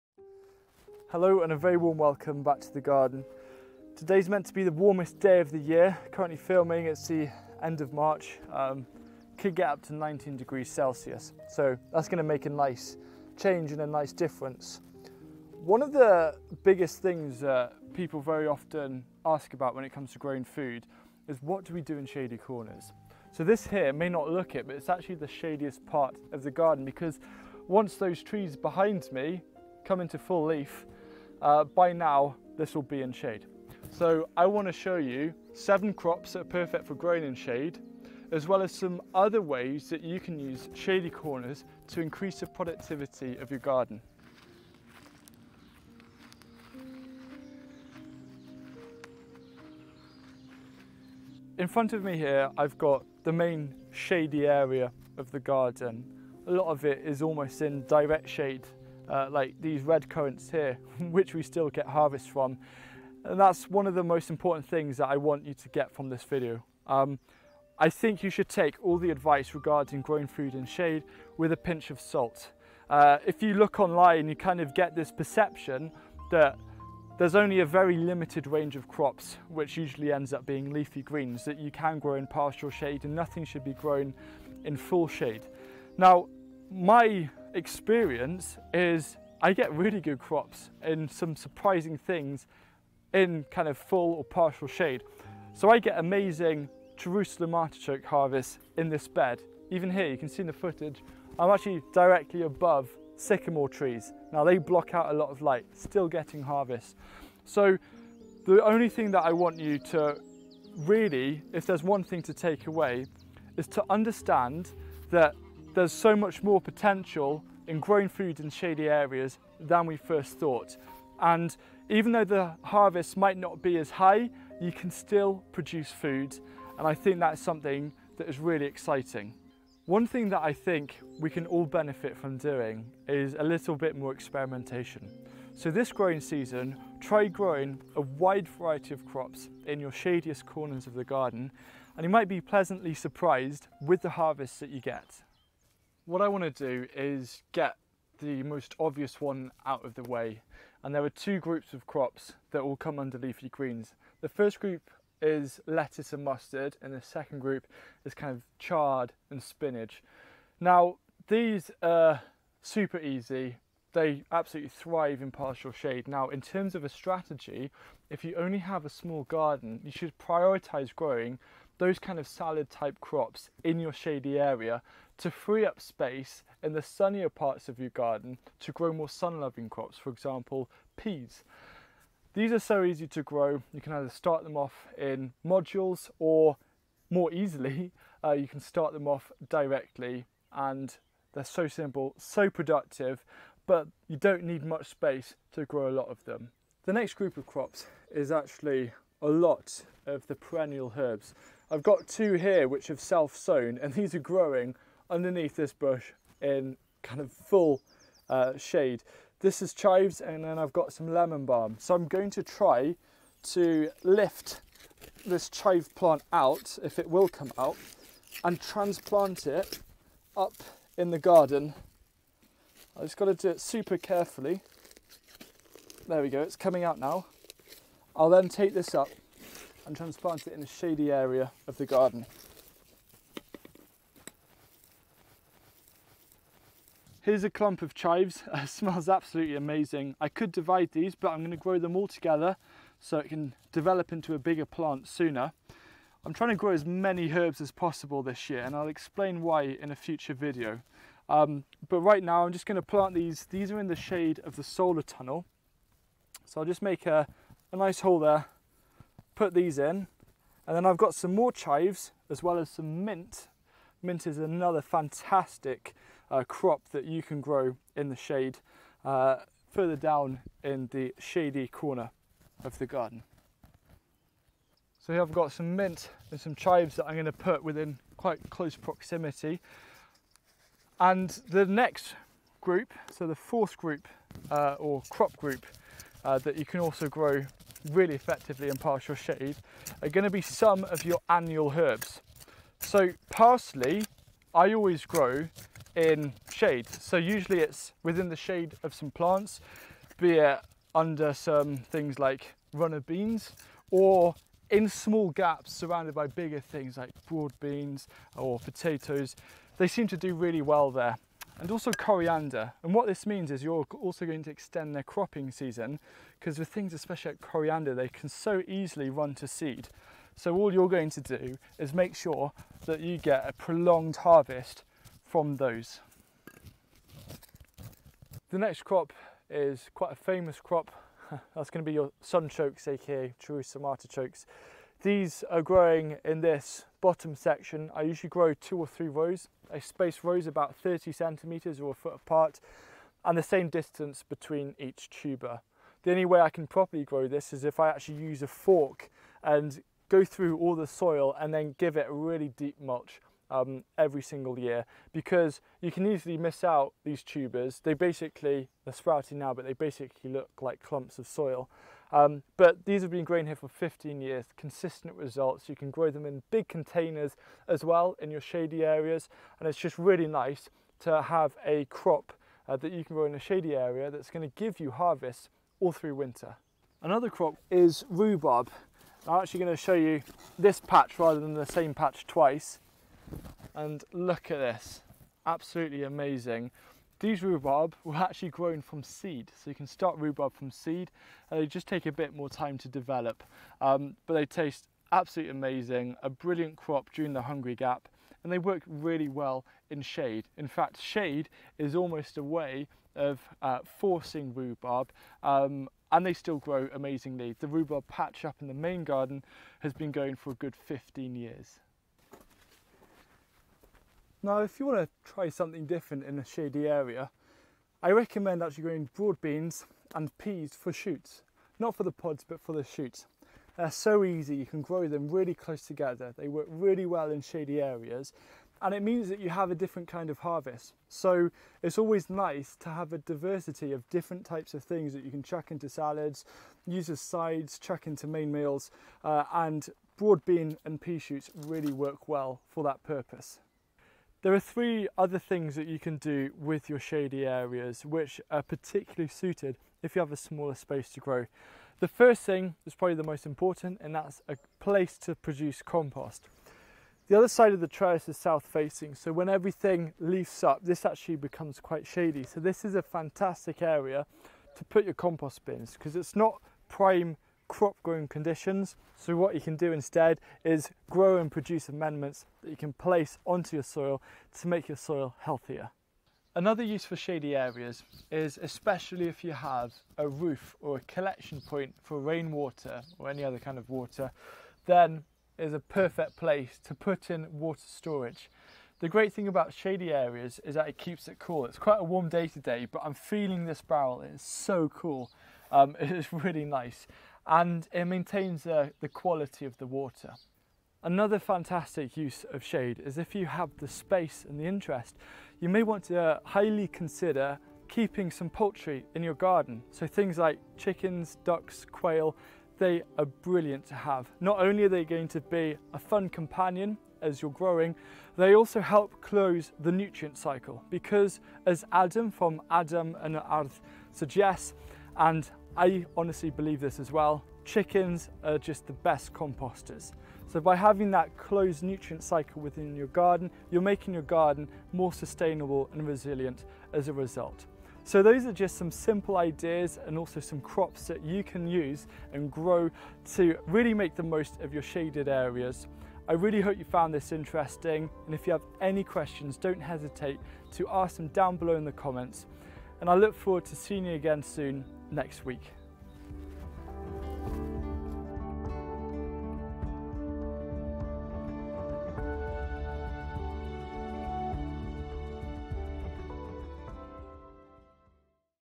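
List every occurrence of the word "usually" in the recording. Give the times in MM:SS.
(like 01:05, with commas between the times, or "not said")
01:19, 04:57, 05:38.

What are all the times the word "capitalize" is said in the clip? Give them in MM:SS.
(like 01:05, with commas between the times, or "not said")
not said.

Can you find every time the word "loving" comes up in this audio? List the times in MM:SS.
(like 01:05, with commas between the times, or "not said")
02:59.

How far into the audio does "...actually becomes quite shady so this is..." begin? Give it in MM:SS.
07:41.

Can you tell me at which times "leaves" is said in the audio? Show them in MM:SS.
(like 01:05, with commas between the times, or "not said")
07:40.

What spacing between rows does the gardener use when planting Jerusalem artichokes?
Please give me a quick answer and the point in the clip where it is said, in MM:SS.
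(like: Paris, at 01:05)
30 centimeters, at 05:40.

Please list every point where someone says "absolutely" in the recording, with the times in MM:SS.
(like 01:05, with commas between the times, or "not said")
02:44, 03:59, 06:25, 06:35.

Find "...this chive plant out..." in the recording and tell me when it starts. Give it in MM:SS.
03:35.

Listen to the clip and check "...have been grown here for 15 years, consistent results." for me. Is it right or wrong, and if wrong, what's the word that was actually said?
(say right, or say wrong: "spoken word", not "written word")
right.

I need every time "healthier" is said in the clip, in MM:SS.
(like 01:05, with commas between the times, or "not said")
07:55.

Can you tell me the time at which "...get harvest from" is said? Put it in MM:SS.
01:01.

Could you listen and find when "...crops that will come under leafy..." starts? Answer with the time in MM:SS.
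02:31.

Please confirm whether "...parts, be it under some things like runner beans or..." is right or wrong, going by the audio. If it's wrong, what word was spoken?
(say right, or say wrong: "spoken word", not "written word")
wrong: "plants", not "parts".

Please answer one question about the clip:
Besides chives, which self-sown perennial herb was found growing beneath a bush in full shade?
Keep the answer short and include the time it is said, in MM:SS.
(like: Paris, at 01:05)
Lemon balm, at 03:31.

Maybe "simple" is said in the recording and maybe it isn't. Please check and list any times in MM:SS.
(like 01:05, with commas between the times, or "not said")
03:11, 08:58.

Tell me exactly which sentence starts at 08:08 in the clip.
The great thing about shady areas is that it keeps it cool.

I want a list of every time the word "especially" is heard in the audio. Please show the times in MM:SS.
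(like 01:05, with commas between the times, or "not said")
05:16, 07:58.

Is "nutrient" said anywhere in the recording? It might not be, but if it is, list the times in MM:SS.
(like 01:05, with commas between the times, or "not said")
08:39, 08:51.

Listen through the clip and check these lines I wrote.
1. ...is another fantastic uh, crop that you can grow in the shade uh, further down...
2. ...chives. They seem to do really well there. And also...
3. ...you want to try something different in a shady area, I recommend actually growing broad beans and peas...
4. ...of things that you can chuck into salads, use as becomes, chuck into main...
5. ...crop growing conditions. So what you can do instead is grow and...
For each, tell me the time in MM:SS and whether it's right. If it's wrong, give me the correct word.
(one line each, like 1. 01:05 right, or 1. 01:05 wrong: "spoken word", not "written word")
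1. 04:24 right
2. 05:08 wrong: "potatoes", not "chives"
3. 06:54 right
4. 07:14 wrong: "sides", not "becomes"
5. 07:47 right.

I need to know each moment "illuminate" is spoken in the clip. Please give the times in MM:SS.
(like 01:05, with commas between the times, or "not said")
not said.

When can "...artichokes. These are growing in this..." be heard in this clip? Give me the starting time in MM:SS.
05:33.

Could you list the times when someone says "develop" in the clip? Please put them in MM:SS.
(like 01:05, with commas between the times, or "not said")
04:03, 06:32.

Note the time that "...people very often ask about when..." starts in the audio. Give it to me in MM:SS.
00:17.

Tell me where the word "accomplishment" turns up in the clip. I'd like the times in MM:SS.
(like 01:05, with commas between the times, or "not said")
not said.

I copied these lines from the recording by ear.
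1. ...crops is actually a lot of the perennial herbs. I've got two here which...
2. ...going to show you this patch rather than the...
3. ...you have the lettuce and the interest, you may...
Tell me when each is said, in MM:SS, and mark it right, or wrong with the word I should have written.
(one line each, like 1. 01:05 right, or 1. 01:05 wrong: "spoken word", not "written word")
1. 03:17 right
2. 06:19 right
3. 08:23 wrong: "space", not "lettuce".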